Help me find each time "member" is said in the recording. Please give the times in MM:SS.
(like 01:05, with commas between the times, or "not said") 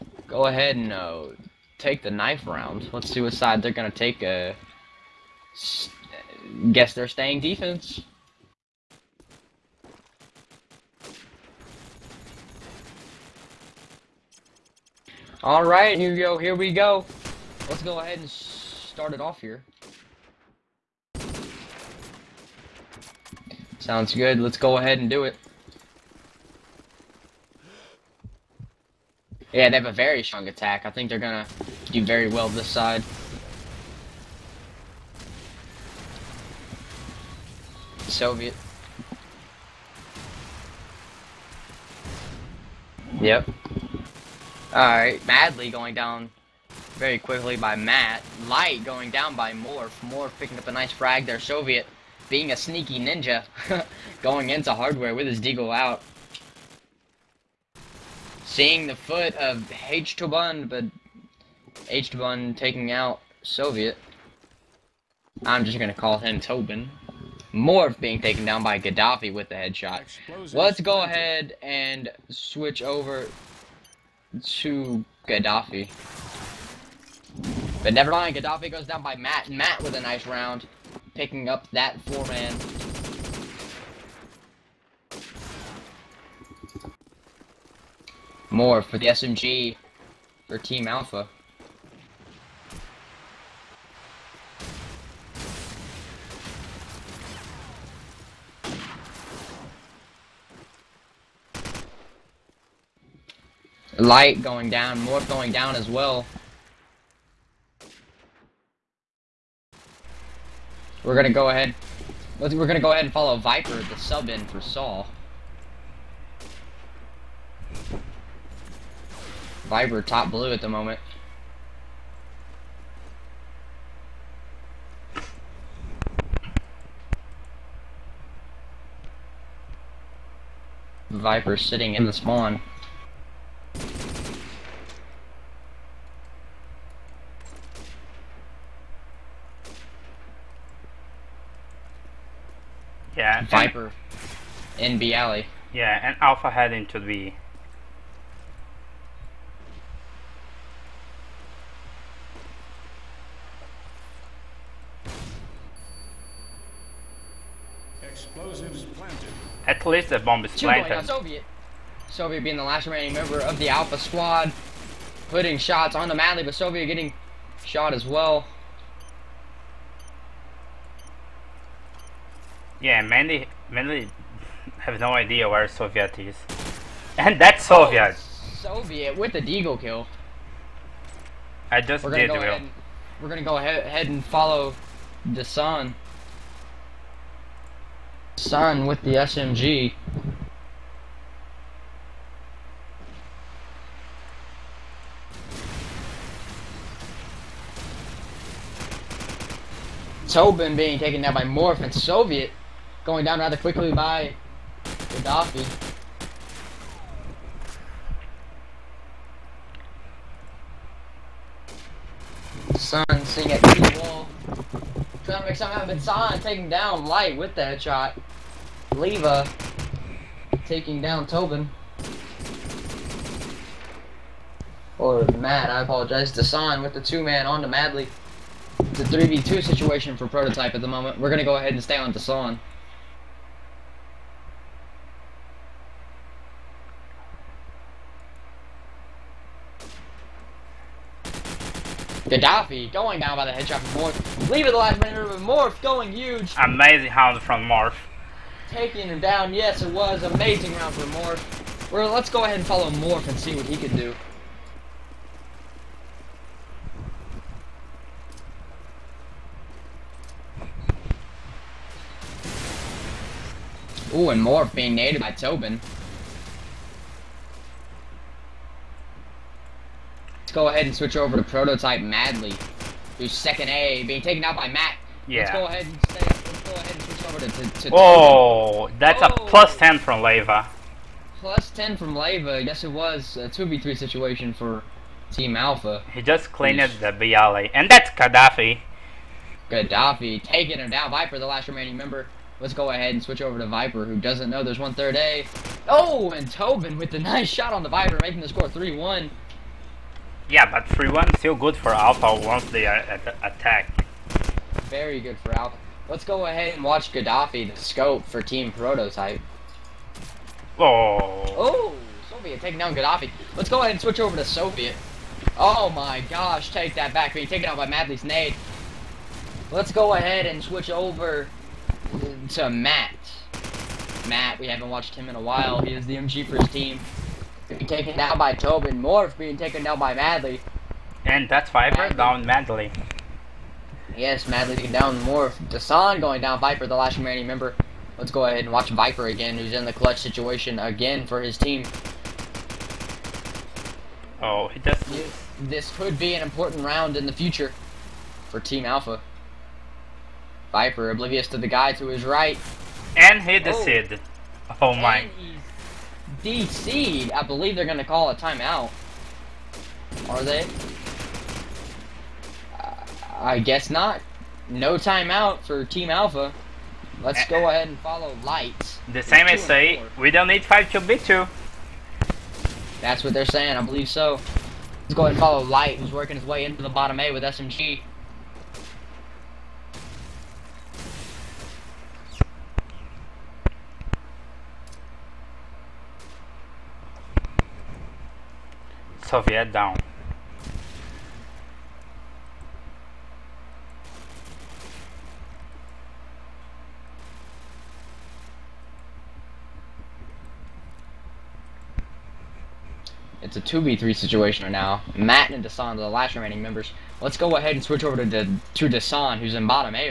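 02:43, 04:51, 05:37, 06:46.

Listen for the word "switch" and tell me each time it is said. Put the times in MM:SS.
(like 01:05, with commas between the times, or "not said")
01:12, 04:30, 04:37, 04:53, 05:14, 05:20, 06:47.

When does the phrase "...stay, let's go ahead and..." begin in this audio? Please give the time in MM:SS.
04:36.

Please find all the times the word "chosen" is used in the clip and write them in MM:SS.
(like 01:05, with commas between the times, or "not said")
not said.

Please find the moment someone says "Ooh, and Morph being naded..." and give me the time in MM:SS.
04:24.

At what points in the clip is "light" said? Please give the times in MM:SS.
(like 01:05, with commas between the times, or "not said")
00:48, 01:43, 03:37, 06:08, 06:15.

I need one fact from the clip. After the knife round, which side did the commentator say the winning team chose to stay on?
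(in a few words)
Defense.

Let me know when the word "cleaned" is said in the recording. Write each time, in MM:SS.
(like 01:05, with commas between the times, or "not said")
04:46.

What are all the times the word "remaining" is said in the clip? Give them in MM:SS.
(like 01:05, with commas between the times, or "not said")
02:42, 04:51, 05:37, 06:46.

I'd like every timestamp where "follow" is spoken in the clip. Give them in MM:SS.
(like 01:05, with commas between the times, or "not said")
01:53, 03:04, 04:12, 06:07, 06:15.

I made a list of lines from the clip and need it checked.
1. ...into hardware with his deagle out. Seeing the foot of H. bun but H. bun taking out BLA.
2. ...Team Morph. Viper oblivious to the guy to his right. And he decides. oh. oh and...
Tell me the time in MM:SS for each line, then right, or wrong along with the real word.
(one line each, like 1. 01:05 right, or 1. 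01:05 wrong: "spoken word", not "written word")
1. 00:54 wrong: "Soviet", not "BLA"
2. 05:48 wrong: "Alfa", not "Morph".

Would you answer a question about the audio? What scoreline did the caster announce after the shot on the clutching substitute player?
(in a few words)
3-1.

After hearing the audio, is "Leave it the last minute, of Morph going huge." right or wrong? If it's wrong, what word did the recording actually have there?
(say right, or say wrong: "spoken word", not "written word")
right.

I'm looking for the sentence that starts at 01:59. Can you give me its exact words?
Viper top blue at the moment.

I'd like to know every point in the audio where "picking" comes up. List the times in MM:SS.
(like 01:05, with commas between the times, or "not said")
00:50, 01:21.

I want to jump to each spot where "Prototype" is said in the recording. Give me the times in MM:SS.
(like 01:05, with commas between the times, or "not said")
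03:50, 04:31, 05:08.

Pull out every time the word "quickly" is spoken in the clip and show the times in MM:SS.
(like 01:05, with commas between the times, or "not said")
00:47, 03:23.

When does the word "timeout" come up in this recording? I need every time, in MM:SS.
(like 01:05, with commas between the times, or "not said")
05:58, 06:04.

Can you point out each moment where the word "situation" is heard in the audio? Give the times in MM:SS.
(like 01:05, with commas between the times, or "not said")
03:49, 04:43, 05:40, 06:44.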